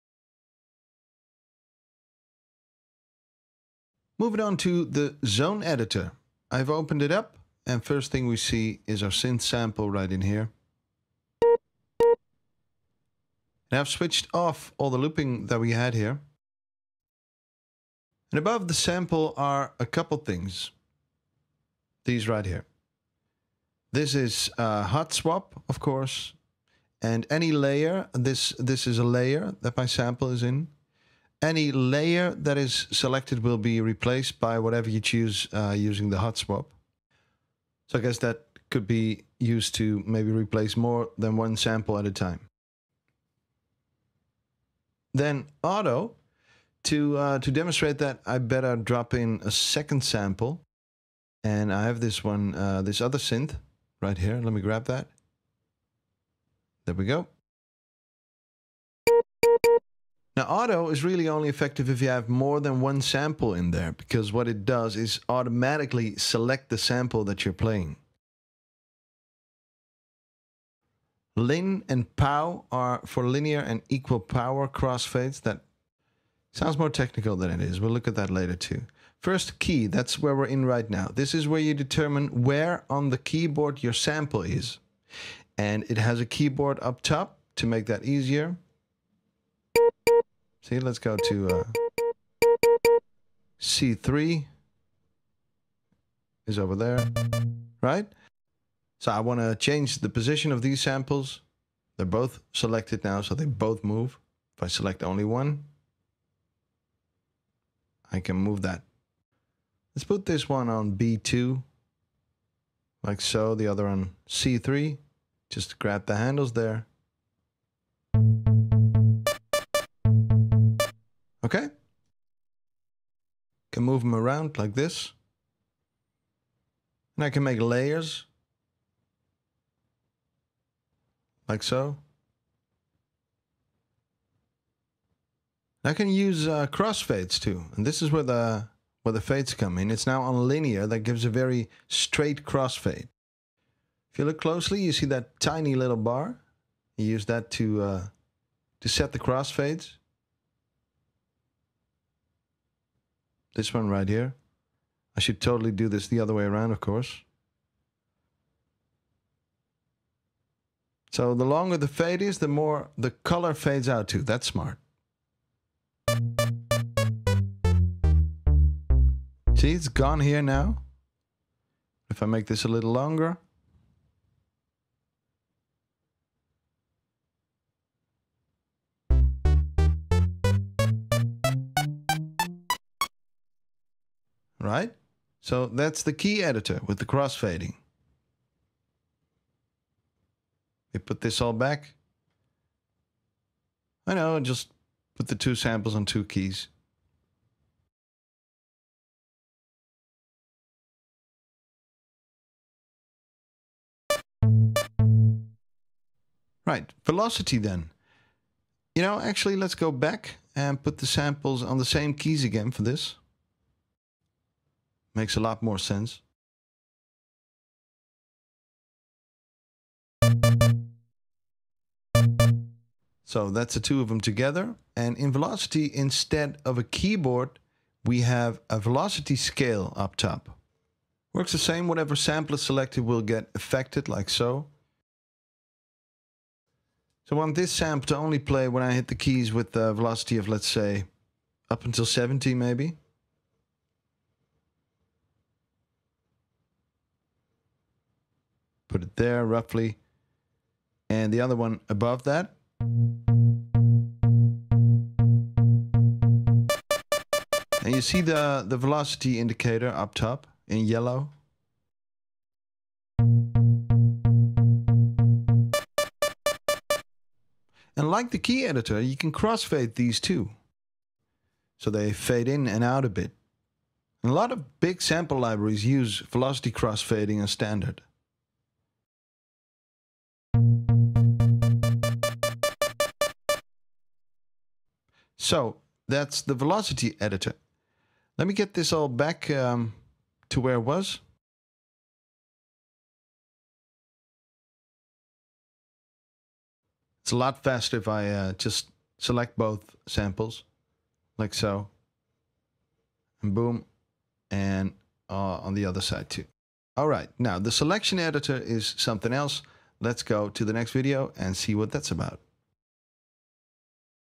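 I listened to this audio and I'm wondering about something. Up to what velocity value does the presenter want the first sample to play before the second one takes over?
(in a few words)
70.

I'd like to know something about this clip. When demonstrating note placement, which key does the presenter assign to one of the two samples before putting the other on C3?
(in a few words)
B2.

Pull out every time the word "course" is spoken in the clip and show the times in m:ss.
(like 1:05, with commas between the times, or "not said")
0:25, 2:36.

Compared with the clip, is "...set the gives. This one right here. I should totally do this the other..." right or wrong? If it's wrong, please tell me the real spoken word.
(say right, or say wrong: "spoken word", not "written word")
wrong: "crossfades", not "gives".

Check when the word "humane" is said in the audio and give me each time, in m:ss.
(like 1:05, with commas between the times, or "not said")
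not said.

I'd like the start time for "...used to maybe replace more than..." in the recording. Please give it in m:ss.
0:39.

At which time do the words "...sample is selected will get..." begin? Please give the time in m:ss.
3:52.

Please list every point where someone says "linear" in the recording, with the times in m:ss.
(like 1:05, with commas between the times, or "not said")
1:13, 2:20.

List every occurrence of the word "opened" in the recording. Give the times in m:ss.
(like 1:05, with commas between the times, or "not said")
0:06.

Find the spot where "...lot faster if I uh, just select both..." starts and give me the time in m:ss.
4:57.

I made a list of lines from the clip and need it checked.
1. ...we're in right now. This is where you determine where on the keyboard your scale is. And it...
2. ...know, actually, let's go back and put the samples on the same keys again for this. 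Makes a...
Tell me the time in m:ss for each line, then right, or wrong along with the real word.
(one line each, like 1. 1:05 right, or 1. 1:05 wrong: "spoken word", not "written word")
1. 1:20 wrong: "sample", not "scale"
2. 3:29 right.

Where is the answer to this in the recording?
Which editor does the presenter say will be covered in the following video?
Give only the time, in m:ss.
5:07.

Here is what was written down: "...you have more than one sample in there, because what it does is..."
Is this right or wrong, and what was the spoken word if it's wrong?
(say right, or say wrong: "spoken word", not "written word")
right.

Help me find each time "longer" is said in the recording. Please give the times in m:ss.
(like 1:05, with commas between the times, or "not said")
2:41, 2:52.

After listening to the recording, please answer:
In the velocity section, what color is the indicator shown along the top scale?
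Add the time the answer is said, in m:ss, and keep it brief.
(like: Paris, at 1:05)
Yellow, at 4:20.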